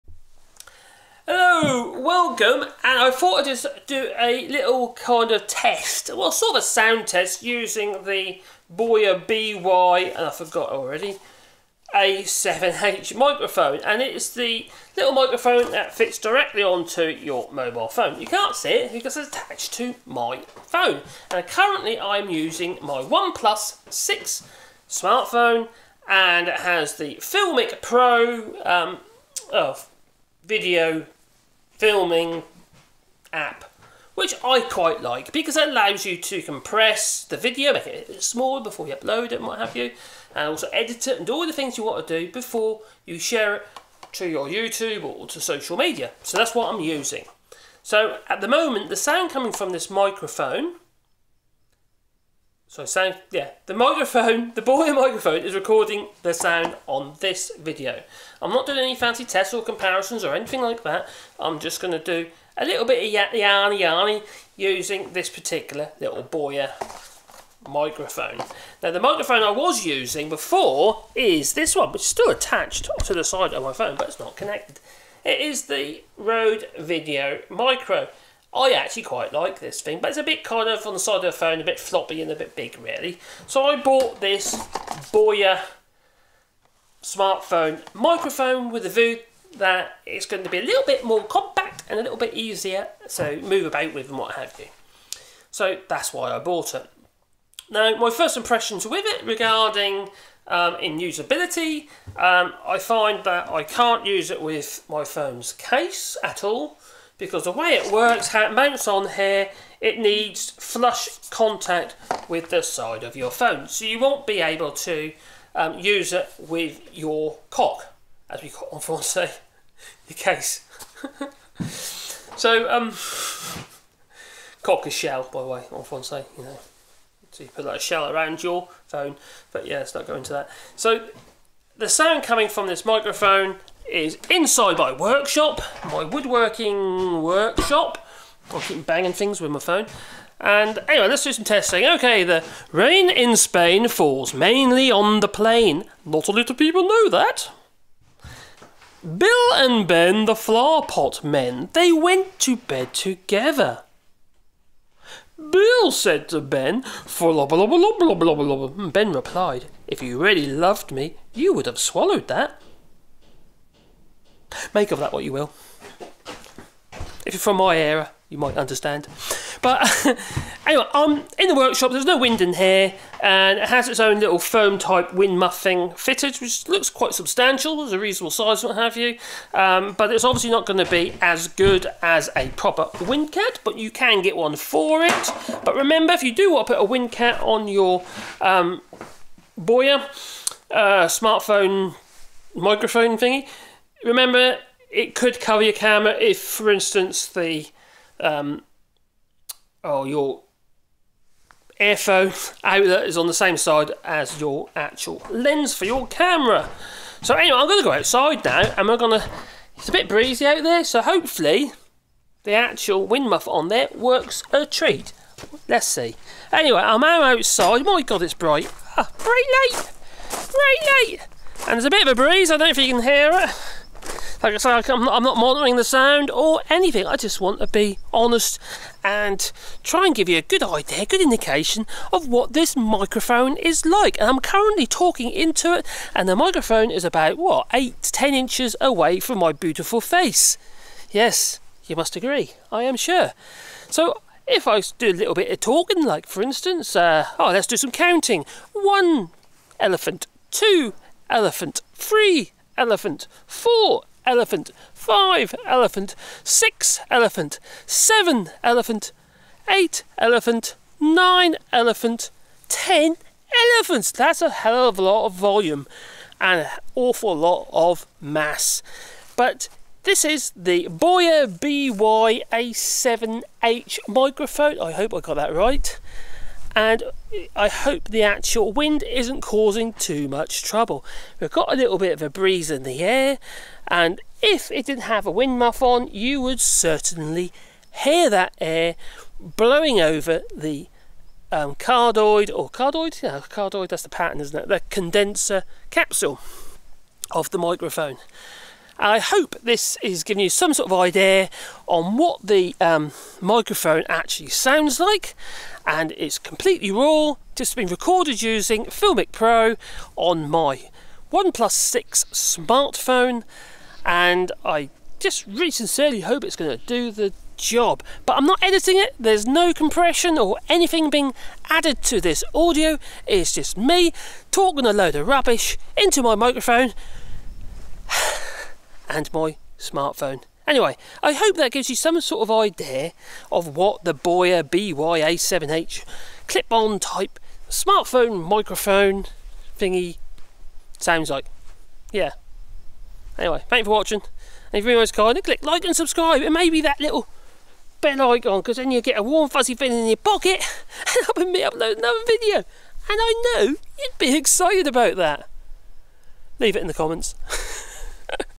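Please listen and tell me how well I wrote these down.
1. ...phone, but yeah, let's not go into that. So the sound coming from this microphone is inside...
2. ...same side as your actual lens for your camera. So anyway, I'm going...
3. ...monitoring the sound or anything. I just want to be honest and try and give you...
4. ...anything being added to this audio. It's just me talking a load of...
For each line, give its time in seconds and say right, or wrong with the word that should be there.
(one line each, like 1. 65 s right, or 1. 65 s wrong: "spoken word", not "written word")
1. 128 s right
2. 203 s right
3. 225 s right
4. 320 s right.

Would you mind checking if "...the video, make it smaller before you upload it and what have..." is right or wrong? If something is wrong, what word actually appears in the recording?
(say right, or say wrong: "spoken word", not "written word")
right.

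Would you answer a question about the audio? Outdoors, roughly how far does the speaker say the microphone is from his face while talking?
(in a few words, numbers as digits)
8 to 10 inches.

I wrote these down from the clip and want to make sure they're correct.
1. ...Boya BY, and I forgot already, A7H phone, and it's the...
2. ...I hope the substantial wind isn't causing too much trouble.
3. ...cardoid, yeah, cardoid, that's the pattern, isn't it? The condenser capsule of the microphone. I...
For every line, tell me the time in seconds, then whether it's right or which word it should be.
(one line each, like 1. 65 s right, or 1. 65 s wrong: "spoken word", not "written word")
1. 8 s wrong: "microphone", not "phone"
2. 277 s wrong: "actual", not "substantial"
3. 292 s right.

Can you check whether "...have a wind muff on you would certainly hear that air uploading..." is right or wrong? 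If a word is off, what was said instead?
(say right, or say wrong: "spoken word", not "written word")
wrong: "blowing", not "uploading".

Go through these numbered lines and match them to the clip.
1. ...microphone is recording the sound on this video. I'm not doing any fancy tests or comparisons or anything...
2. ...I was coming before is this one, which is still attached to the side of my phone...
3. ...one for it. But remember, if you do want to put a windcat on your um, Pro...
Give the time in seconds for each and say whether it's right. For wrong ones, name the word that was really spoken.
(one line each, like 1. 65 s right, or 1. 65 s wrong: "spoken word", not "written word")
1. 54 s right
2. 69 s wrong: "using", not "coming"
3. 184 s wrong: "Boya", not "Pro".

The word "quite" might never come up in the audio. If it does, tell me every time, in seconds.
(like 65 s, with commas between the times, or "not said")
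34 s, 79 s, 176 s.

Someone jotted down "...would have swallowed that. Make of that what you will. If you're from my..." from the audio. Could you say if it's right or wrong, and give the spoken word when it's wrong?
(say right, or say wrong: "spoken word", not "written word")
right.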